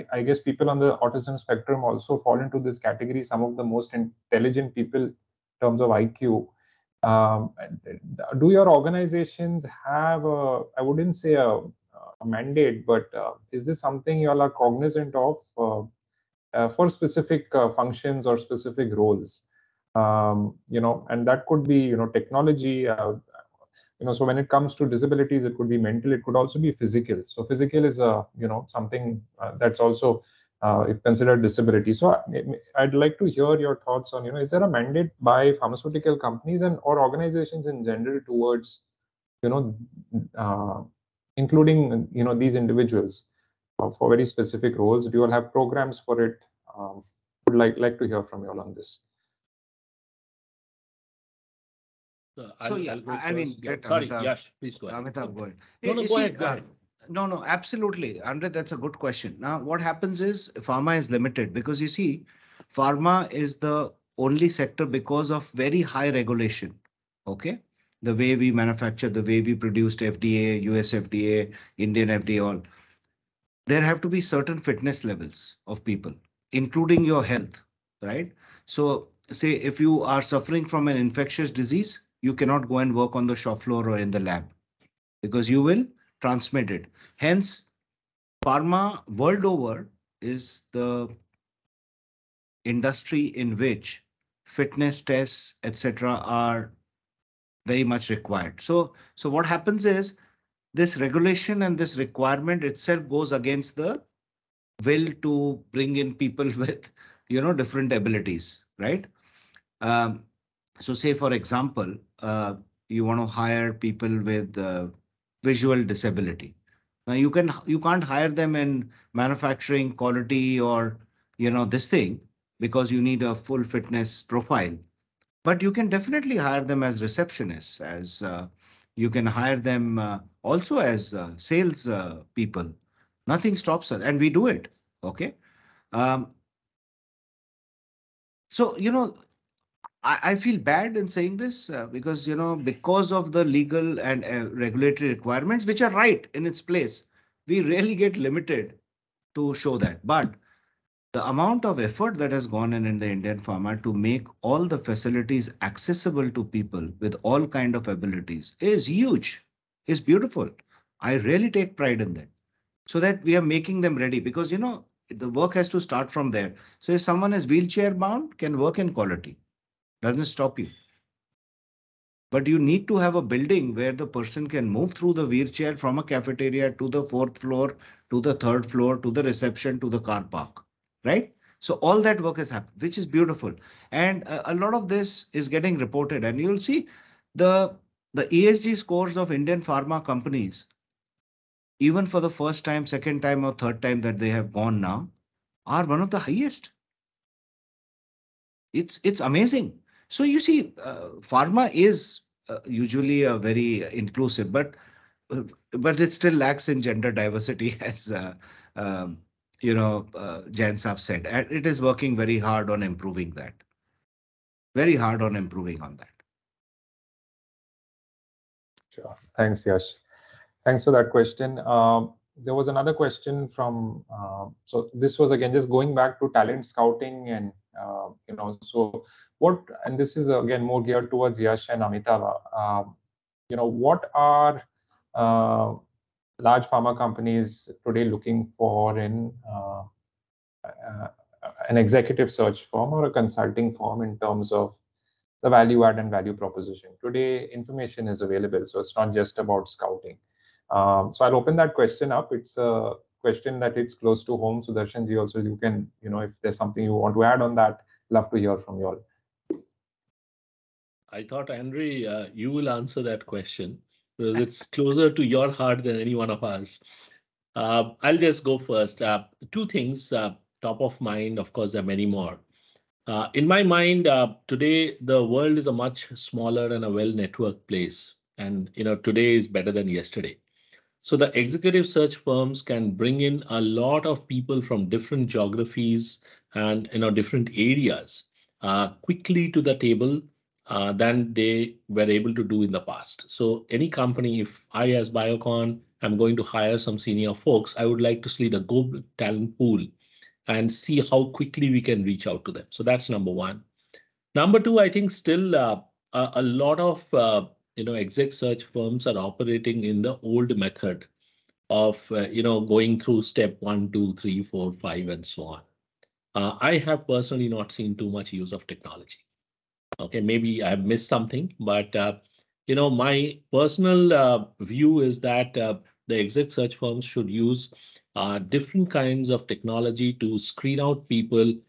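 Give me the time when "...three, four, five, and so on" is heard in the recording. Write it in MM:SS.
05:14.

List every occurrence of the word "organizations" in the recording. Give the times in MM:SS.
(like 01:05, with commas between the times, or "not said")
00:08, 00:36.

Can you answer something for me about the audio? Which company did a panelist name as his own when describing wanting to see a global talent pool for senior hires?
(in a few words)
Biocon.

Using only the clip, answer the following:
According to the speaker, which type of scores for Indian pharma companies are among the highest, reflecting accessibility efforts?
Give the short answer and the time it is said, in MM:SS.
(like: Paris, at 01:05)
ESG scores, at 03:08.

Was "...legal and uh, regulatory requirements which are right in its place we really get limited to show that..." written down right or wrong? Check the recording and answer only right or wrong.
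right.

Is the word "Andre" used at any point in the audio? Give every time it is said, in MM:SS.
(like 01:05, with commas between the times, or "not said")
00:58, 04:21.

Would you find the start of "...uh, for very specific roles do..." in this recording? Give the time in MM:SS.
00:43.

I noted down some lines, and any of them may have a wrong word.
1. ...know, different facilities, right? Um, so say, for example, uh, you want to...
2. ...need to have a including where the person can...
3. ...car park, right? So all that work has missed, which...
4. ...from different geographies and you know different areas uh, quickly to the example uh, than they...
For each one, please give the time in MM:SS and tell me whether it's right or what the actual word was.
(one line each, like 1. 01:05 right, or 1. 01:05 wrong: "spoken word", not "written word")
1. 01:47 wrong: "abilities", not "facilities"
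2. 02:52 wrong: "building", not "including"
3. 02:59 wrong: "happened", not "missed"
4. 04:44 wrong: "table", not "example".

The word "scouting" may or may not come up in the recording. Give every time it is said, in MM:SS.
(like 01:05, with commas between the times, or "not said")
03:46, 04:09.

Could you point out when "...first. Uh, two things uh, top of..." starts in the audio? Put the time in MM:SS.
04:28.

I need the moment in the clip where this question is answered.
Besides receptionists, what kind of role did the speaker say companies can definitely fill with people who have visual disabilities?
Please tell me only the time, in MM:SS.
02:11.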